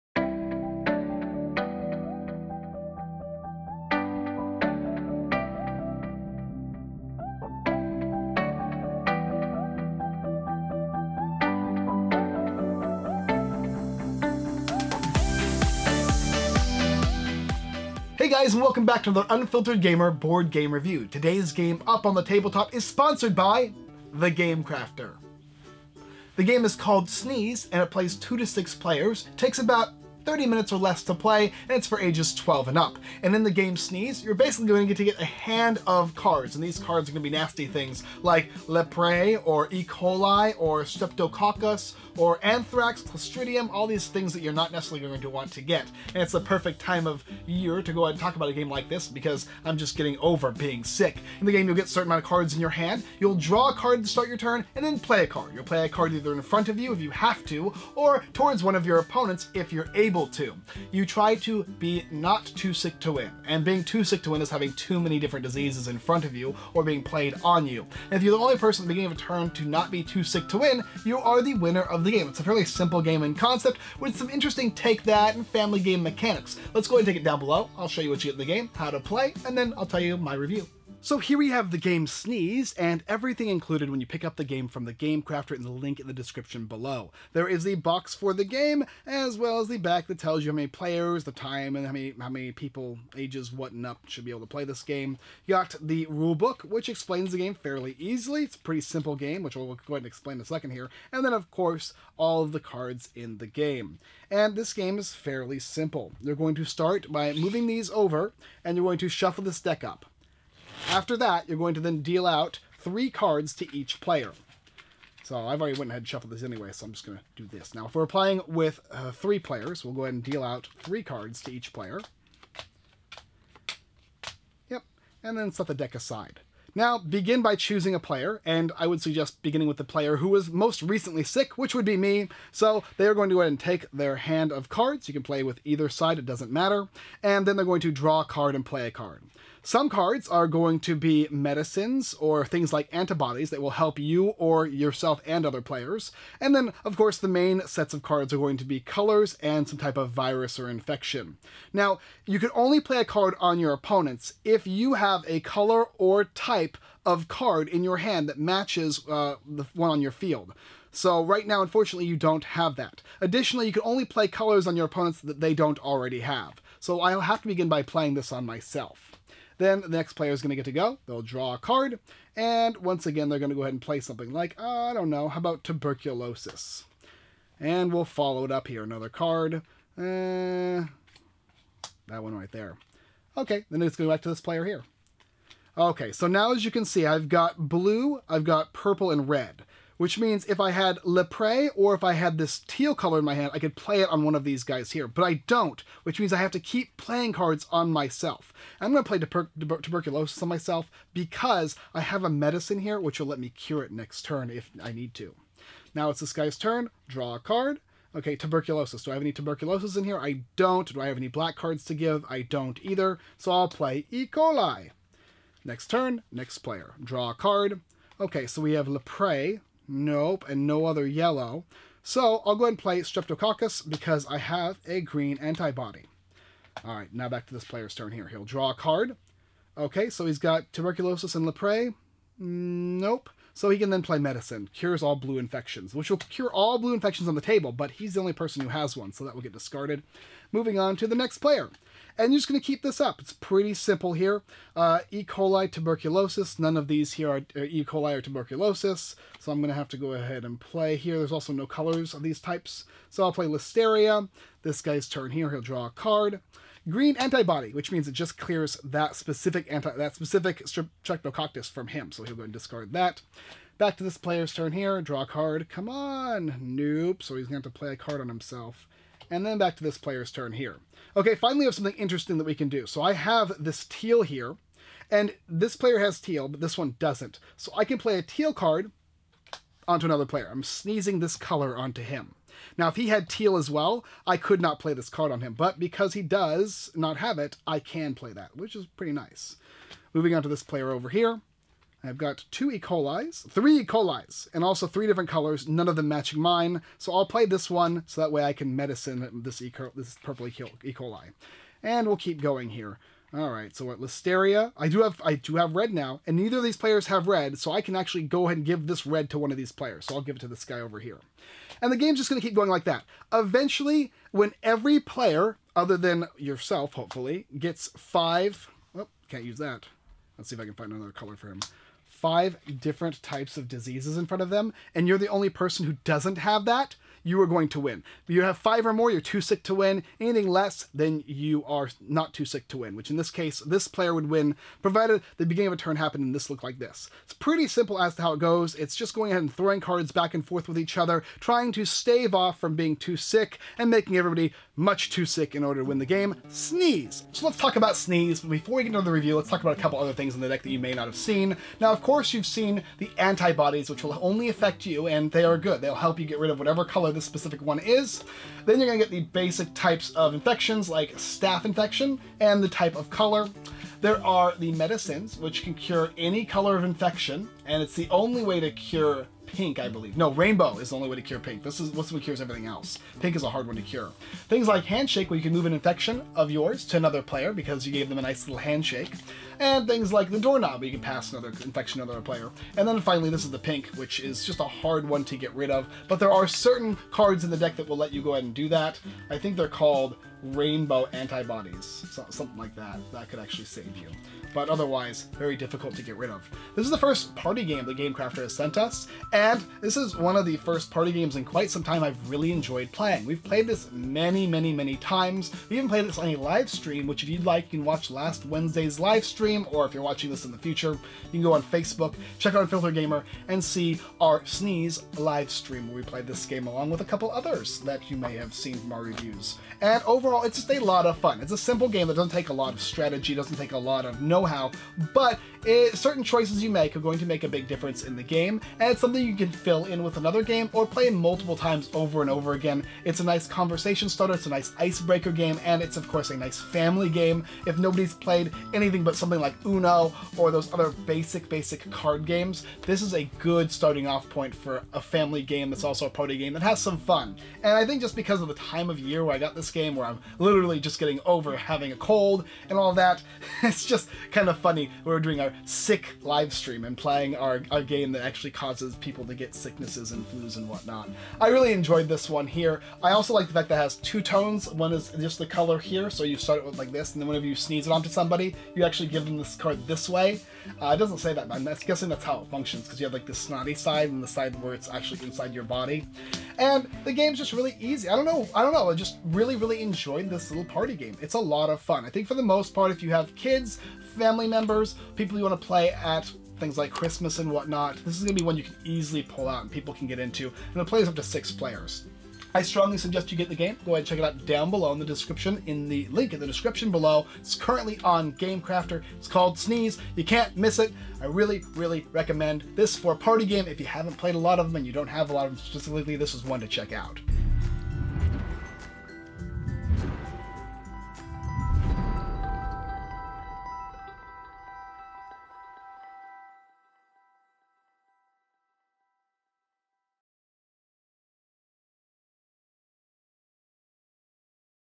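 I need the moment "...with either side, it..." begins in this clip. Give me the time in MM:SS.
02:15.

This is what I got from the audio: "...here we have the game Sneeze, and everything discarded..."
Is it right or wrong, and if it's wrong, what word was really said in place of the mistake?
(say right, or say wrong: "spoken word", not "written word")
wrong: "included", not "discarded".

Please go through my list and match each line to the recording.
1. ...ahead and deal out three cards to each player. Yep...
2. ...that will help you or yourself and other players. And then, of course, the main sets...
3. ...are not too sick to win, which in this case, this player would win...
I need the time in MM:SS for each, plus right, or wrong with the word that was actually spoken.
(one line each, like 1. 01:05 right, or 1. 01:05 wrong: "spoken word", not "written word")
1. 02:00 right
2. 02:23 right
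3. 05:31 right.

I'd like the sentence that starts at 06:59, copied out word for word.
And overall overall, it's just a lot of fun.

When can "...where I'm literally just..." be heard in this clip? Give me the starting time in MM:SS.
07:29.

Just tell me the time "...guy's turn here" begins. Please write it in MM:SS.
04:14.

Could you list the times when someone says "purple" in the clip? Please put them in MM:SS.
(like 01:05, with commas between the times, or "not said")
03:08, 05:00.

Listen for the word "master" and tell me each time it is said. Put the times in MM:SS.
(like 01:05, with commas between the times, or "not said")
not said.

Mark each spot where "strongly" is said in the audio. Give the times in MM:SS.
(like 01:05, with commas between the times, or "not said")
08:12.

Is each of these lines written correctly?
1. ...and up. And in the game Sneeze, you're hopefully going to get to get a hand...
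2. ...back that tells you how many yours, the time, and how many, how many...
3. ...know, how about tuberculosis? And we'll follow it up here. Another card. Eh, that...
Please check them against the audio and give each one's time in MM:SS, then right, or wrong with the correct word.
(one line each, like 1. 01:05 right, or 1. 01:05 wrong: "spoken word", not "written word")
1. 00:32 wrong: "basically", not "hopefully"
2. 01:29 wrong: "players", not "yours"
3. 02:55 right.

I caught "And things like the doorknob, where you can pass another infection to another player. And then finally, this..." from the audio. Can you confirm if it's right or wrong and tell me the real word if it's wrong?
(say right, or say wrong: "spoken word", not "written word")
right.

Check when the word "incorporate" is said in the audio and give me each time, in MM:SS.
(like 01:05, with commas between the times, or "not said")
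not said.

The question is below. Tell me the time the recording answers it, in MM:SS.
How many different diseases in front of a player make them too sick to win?
05:28.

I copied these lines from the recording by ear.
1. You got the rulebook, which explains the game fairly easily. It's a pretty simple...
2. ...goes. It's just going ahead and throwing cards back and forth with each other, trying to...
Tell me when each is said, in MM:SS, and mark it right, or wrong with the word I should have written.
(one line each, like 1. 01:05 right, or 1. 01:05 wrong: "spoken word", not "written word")
1. 01:35 right
2. 05:38 right.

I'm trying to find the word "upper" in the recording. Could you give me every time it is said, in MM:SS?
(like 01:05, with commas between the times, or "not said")
not said.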